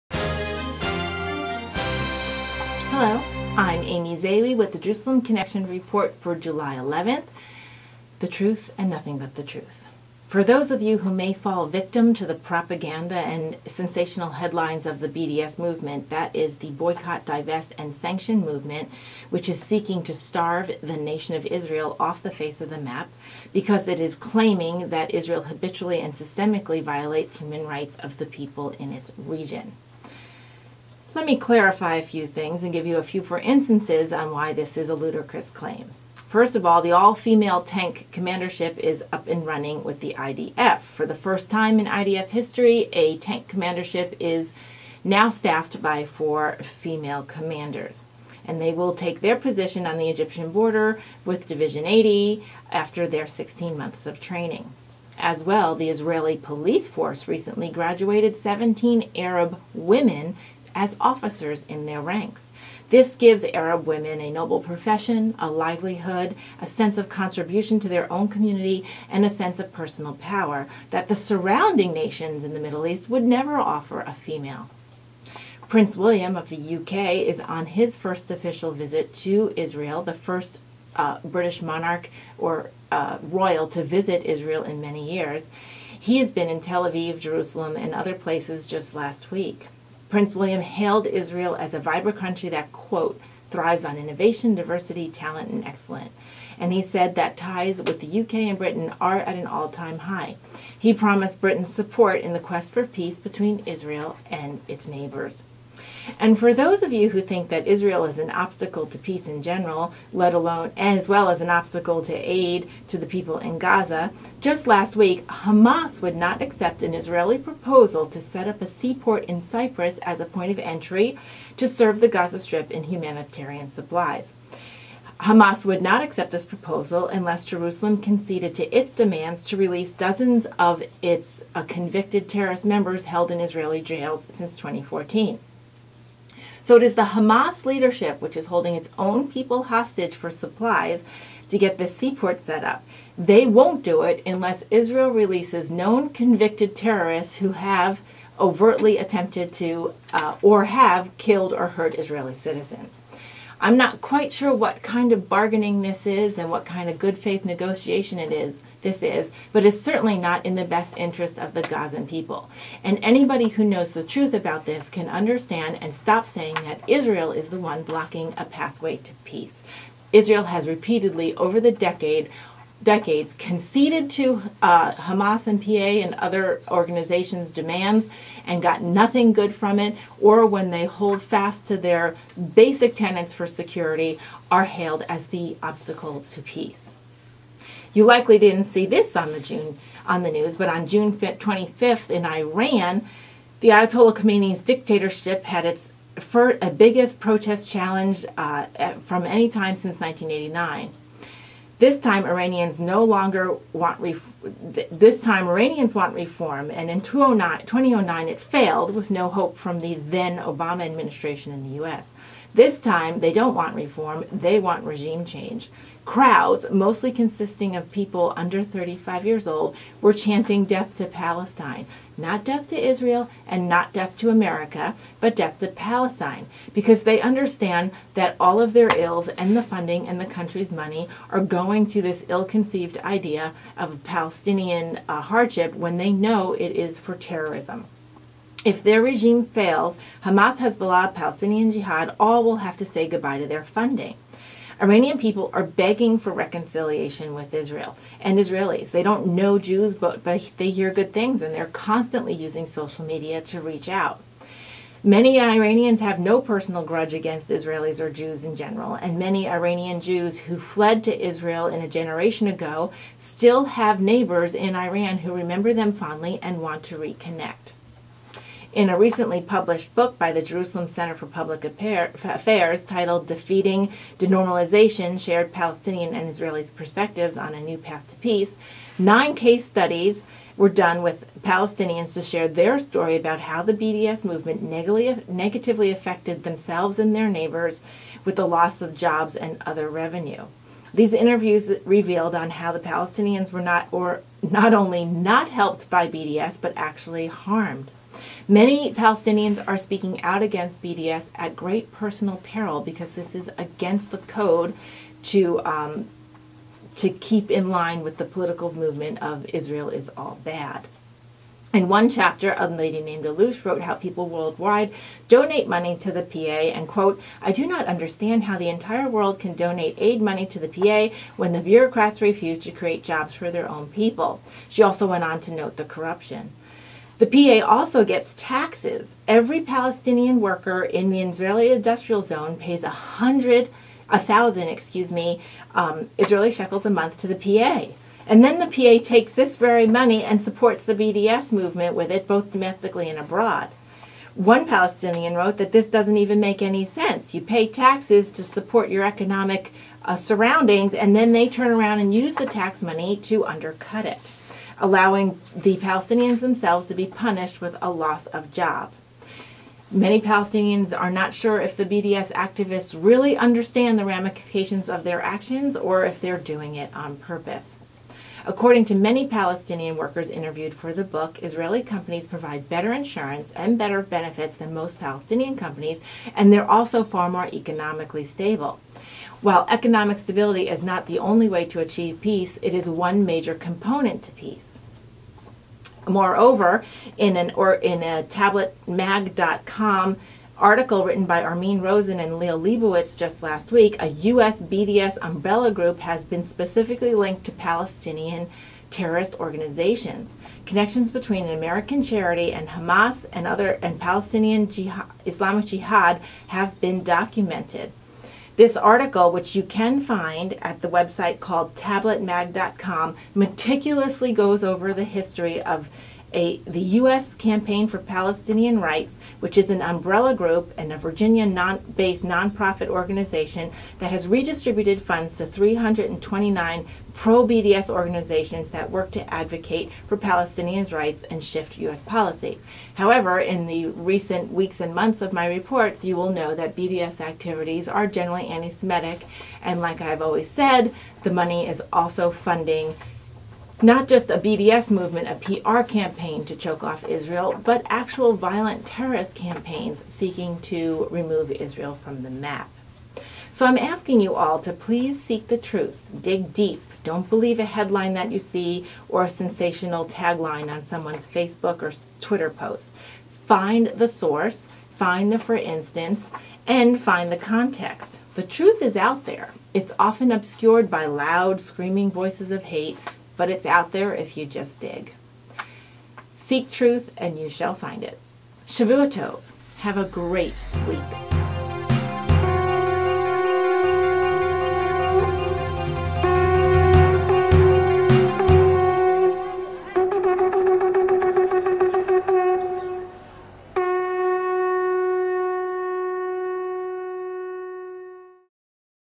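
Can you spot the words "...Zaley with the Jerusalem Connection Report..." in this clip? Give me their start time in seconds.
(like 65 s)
4 s.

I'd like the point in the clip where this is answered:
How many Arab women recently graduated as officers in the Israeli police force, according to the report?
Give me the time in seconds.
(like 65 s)
58 s.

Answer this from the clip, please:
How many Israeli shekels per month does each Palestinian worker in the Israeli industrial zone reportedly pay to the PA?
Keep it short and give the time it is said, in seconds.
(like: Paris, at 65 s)
1,000, at 334 s.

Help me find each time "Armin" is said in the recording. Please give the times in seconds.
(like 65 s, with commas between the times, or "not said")
391 s.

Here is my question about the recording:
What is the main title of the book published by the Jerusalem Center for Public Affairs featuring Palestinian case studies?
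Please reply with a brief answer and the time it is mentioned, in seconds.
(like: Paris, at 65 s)
Defeating Denormalization, at 273 s.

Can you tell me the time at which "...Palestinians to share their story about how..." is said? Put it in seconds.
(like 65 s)
281 s.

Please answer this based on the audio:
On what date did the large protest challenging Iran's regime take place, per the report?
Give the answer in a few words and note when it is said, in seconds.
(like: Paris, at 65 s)
June 25, at 190 s.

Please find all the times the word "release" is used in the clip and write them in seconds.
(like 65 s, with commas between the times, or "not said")
129 s, 145 s.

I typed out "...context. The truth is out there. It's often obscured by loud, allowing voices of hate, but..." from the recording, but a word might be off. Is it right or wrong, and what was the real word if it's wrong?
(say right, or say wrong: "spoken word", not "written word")
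wrong: "screaming", not "allowing".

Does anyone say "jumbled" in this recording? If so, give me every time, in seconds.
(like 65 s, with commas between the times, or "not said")
not said.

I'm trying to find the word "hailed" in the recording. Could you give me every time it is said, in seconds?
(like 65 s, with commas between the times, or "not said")
90 s, 184 s.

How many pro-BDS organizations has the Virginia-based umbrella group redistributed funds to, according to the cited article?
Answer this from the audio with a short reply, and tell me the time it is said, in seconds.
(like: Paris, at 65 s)
329, at 425 s.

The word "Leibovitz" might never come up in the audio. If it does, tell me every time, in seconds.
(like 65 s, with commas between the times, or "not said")
392 s.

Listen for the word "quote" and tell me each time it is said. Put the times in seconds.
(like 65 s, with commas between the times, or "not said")
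92 s, 316 s.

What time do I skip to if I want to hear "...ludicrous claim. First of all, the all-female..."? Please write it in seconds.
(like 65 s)
34 s.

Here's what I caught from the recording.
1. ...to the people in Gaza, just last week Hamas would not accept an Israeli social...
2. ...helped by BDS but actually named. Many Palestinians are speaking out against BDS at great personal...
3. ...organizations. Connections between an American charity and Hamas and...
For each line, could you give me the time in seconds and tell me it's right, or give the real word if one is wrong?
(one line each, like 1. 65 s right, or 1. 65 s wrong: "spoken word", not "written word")
1. 112 s wrong: "proposal", not "social"
2. 295 s wrong: "harmed", not "named"
3. 399 s right.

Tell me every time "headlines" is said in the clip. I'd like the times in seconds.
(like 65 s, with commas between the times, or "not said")
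14 s, 457 s.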